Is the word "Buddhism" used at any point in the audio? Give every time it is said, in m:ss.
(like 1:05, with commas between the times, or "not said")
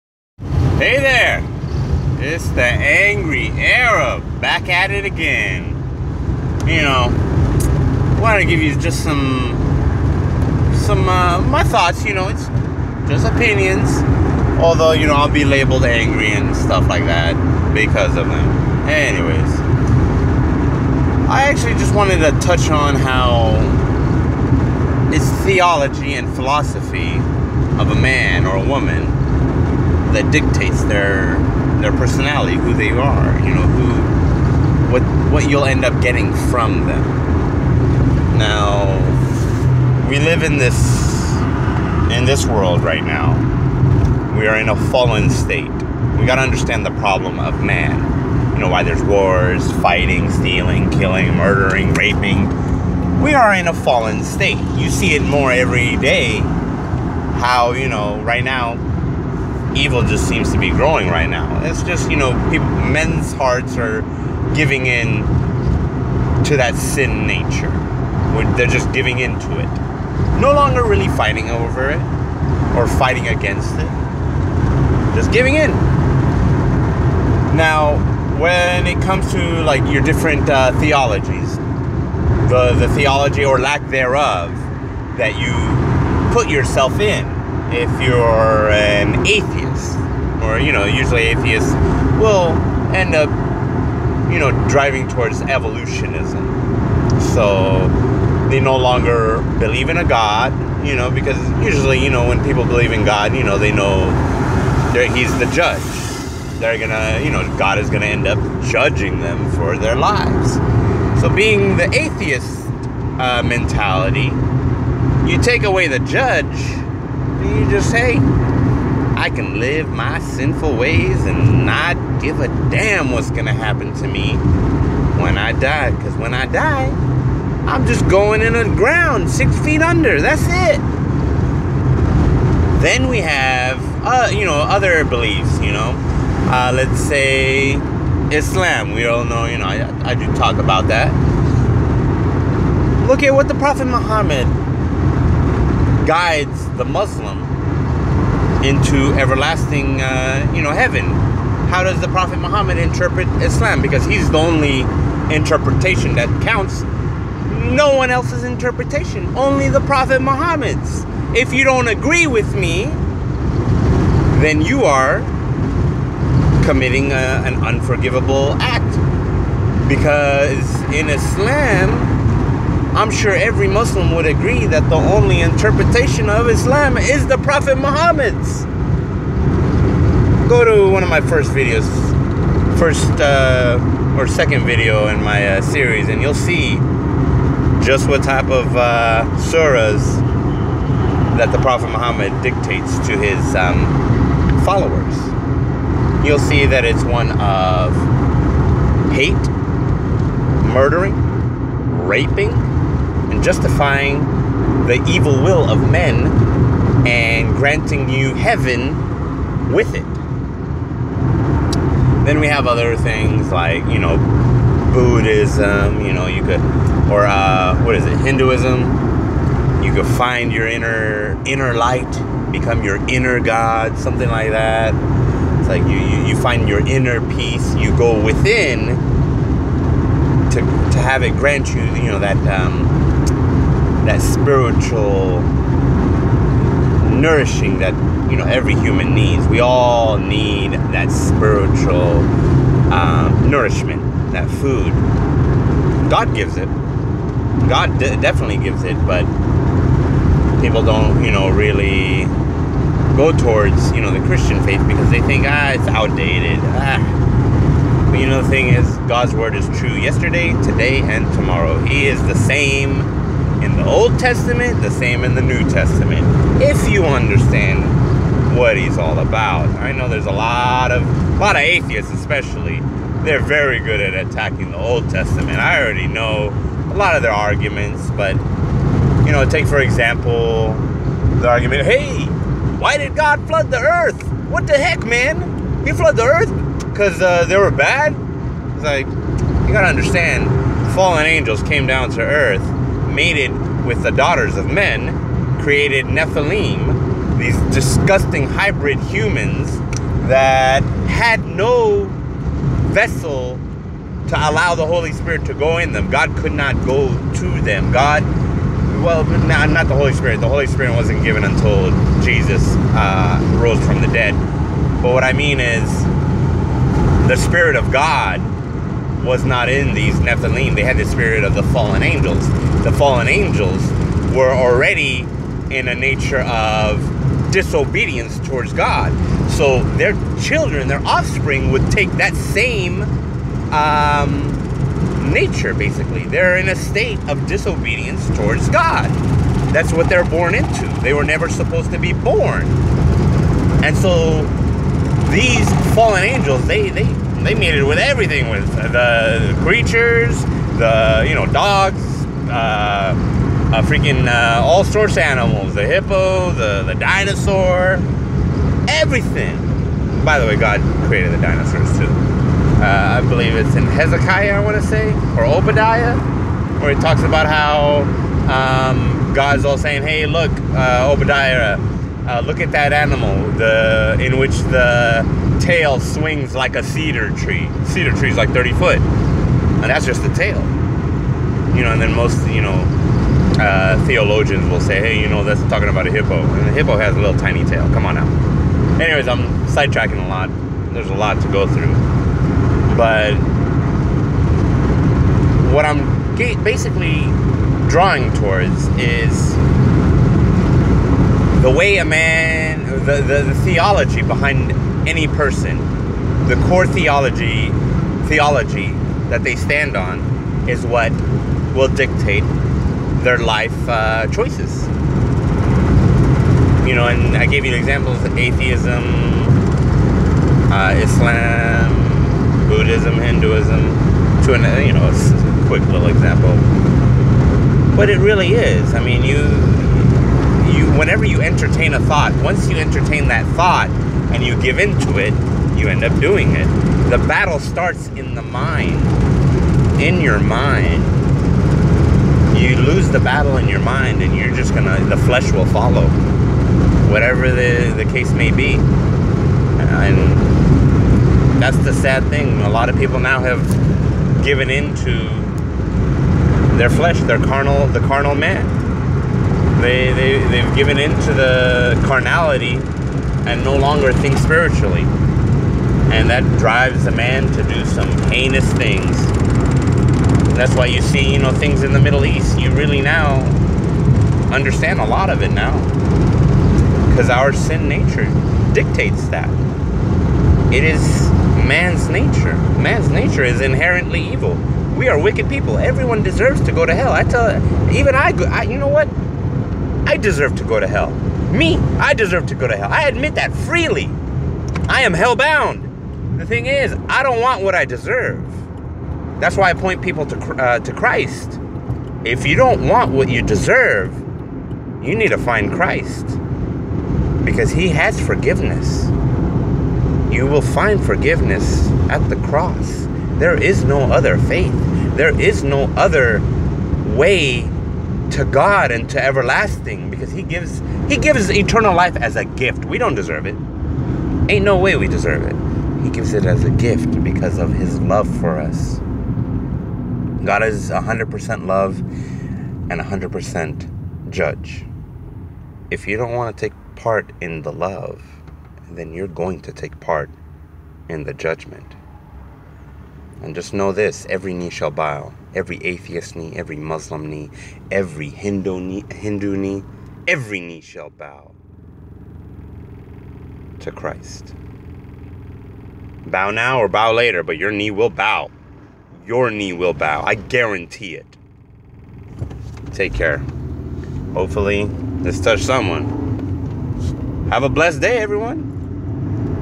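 3:34, 7:02.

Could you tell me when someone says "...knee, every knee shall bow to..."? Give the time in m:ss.
9:09.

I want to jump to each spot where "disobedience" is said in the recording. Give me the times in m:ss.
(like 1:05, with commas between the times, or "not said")
5:27, 5:37.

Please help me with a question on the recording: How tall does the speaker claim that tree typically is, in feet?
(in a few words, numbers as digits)
30 feet.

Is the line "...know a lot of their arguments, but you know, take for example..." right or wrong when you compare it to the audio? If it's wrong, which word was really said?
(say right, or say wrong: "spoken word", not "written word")
right.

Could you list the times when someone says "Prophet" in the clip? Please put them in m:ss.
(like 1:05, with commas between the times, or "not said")
2:23, 2:32, 2:39, 2:57, 3:11.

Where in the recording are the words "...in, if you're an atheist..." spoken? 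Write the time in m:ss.
1:26.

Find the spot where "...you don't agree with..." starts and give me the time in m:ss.
2:41.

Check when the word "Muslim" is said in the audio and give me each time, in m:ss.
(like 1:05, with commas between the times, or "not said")
2:26, 2:53, 9:06.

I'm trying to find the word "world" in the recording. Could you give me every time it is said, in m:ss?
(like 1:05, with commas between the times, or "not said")
0:42.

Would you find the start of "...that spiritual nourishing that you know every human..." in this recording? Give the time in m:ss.
3:54.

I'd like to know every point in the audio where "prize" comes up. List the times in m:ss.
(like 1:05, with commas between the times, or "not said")
not said.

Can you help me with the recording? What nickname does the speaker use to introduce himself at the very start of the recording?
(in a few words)
The angry Arab.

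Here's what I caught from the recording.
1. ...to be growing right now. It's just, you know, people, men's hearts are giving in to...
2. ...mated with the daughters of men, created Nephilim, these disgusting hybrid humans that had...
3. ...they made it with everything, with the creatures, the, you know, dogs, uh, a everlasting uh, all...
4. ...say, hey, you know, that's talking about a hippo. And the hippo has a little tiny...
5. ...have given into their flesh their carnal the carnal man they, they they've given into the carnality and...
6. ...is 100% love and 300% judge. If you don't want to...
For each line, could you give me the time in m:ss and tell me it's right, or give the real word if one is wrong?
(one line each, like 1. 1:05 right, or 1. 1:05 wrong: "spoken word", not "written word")
1. 1:00 right
2. 4:53 right
3. 5:47 wrong: "freaking", not "everlasting"
4. 6:24 right
5. 7:33 right
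6. 8:50 wrong: "100", not "300".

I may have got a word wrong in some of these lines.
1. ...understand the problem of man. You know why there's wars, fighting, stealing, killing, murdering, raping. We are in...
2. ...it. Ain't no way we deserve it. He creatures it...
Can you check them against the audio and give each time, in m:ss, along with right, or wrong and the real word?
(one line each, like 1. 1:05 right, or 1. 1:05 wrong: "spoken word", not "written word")
1. 0:46 right
2. 8:43 wrong: "gives", not "creatures".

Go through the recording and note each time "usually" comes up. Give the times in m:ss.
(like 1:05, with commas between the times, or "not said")
1:30, 1:41.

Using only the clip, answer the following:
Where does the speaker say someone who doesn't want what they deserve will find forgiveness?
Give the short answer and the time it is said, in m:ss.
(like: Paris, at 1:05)
At the cross, at 8:32.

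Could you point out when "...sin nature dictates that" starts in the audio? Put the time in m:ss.
7:57.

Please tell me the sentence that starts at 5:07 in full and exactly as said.
God, well, not, not the Holy Spirit.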